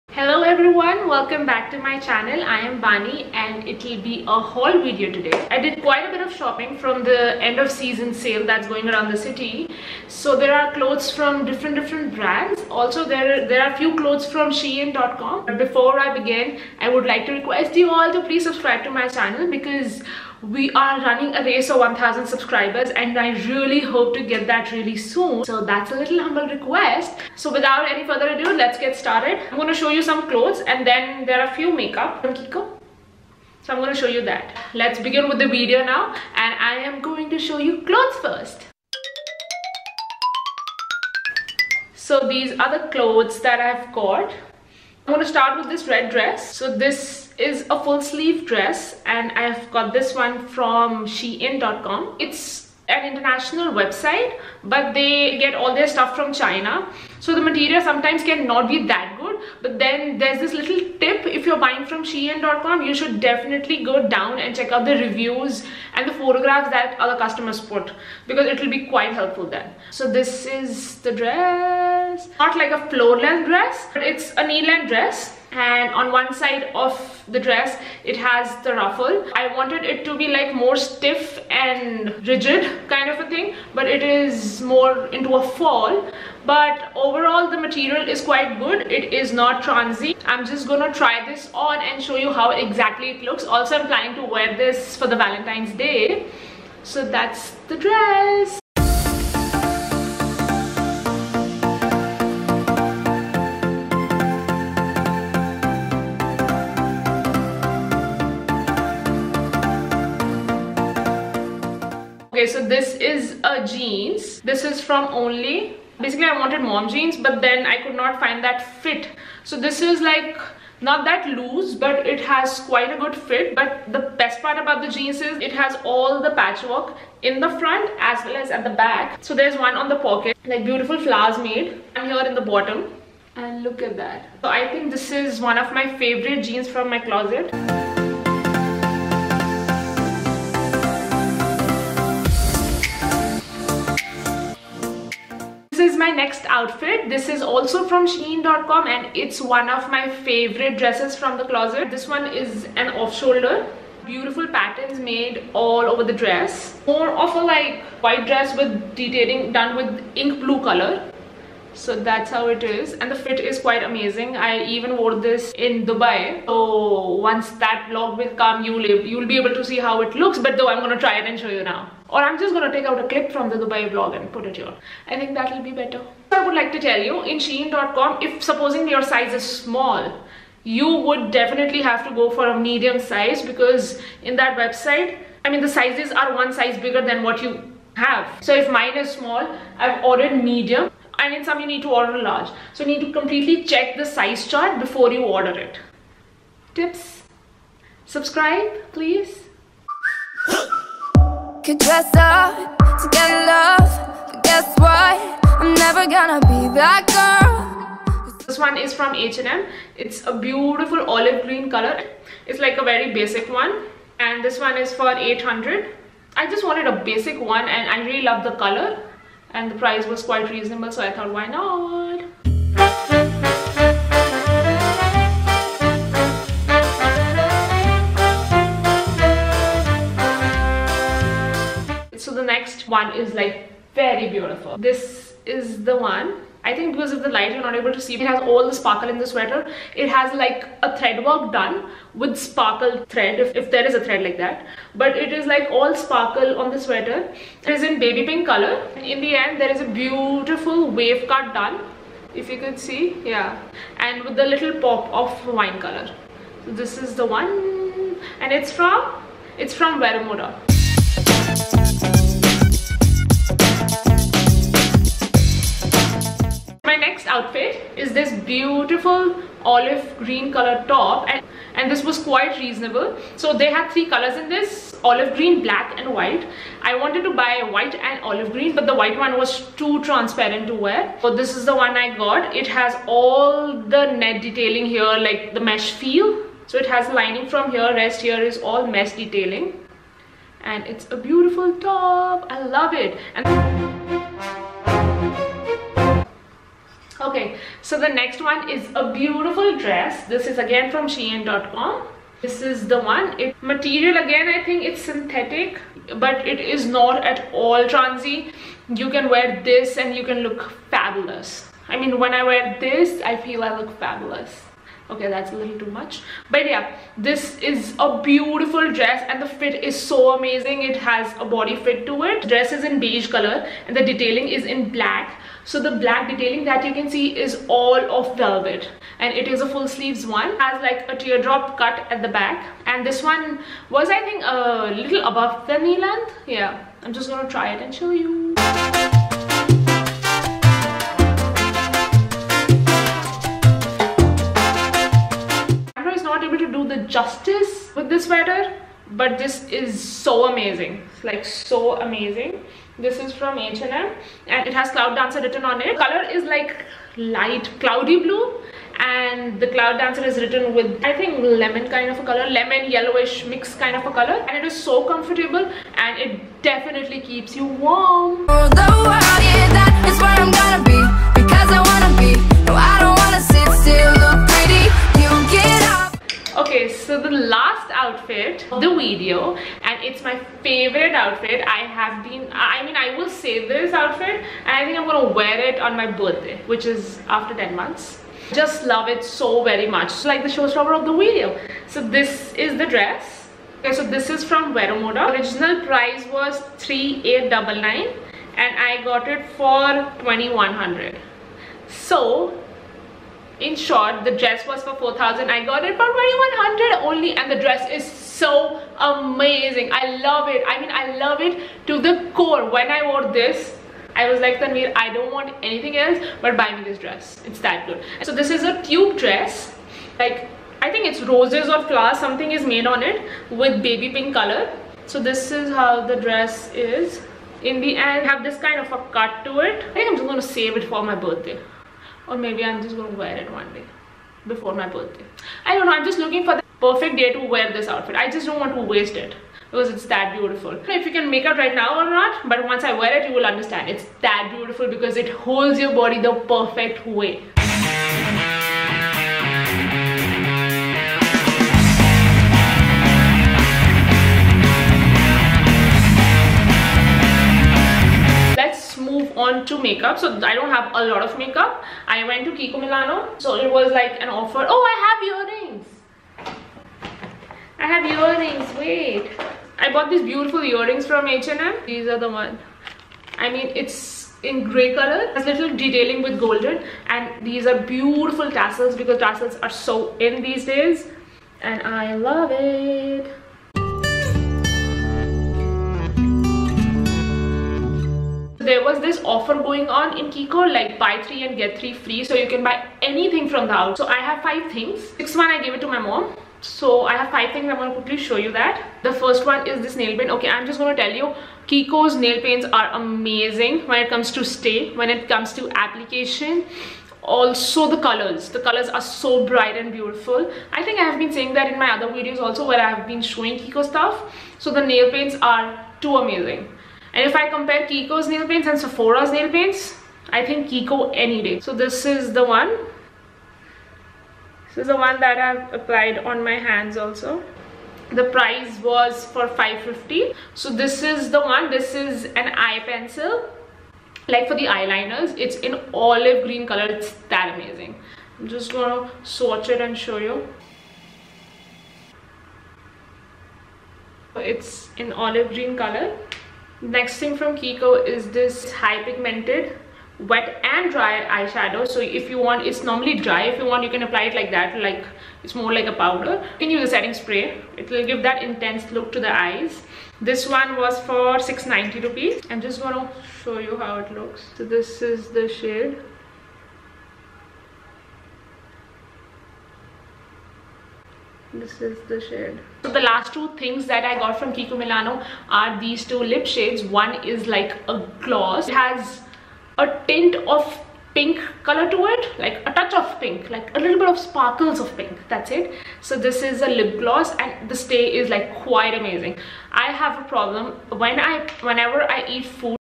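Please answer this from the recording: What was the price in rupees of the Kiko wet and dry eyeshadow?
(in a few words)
690.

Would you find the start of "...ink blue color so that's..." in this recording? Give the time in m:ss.
2:40.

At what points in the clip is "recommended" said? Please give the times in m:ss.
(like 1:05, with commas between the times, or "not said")
not said.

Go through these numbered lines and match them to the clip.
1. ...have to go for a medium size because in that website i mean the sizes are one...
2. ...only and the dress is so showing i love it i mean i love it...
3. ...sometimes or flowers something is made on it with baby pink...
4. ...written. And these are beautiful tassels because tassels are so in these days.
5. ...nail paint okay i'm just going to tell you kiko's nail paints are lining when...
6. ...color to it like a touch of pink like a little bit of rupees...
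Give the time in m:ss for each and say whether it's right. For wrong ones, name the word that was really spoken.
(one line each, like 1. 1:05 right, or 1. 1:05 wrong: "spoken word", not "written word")
1. 3:01 right
2. 6:47 wrong: "amazing", not "showing"
3. 7:01 wrong: "roses", not "sometimes"
4. 7:56 wrong: "golden", not "written"
5. 8:19 wrong: "amazing", not "lining"
6. 9:41 wrong: "sparkles", not "rupees".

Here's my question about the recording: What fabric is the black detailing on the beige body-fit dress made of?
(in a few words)
Velvet.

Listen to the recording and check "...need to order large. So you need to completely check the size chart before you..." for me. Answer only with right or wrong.
right.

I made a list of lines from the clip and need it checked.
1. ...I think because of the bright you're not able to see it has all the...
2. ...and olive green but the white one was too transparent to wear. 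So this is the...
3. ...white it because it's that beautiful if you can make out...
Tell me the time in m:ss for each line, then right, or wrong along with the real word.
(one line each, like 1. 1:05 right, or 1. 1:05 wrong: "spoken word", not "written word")
1. 3:56 wrong: "light", not "bright"
2. 4:37 right
3. 7:18 wrong: "waste", not "white".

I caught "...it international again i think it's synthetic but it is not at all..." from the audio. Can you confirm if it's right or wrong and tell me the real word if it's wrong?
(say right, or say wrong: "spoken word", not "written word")
wrong: "material", not "international".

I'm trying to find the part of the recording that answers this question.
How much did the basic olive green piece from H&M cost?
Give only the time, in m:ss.
3:34.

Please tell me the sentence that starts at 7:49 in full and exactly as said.
I bought these beautiful earrings from H&M.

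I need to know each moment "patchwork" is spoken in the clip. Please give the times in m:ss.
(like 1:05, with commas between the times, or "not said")
2:06.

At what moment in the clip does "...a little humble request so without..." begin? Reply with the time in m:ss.
0:25.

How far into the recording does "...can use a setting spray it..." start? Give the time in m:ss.
9:16.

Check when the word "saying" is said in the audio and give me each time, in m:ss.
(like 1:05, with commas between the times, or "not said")
8:31.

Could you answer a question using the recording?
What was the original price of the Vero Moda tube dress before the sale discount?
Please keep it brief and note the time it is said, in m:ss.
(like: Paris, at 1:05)
3899, at 6:36.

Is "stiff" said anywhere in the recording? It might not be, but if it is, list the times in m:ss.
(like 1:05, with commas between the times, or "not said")
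1:20.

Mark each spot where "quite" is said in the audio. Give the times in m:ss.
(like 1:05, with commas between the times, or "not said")
0:05, 1:08, 1:28, 2:02, 2:43, 3:40, 4:32, 9:48.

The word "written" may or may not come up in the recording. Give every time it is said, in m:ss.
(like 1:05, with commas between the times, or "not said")
5:55, 6:00.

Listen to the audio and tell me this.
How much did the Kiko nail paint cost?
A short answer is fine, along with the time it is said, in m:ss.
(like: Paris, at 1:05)
550, at 8:49.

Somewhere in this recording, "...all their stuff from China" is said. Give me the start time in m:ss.
0:55.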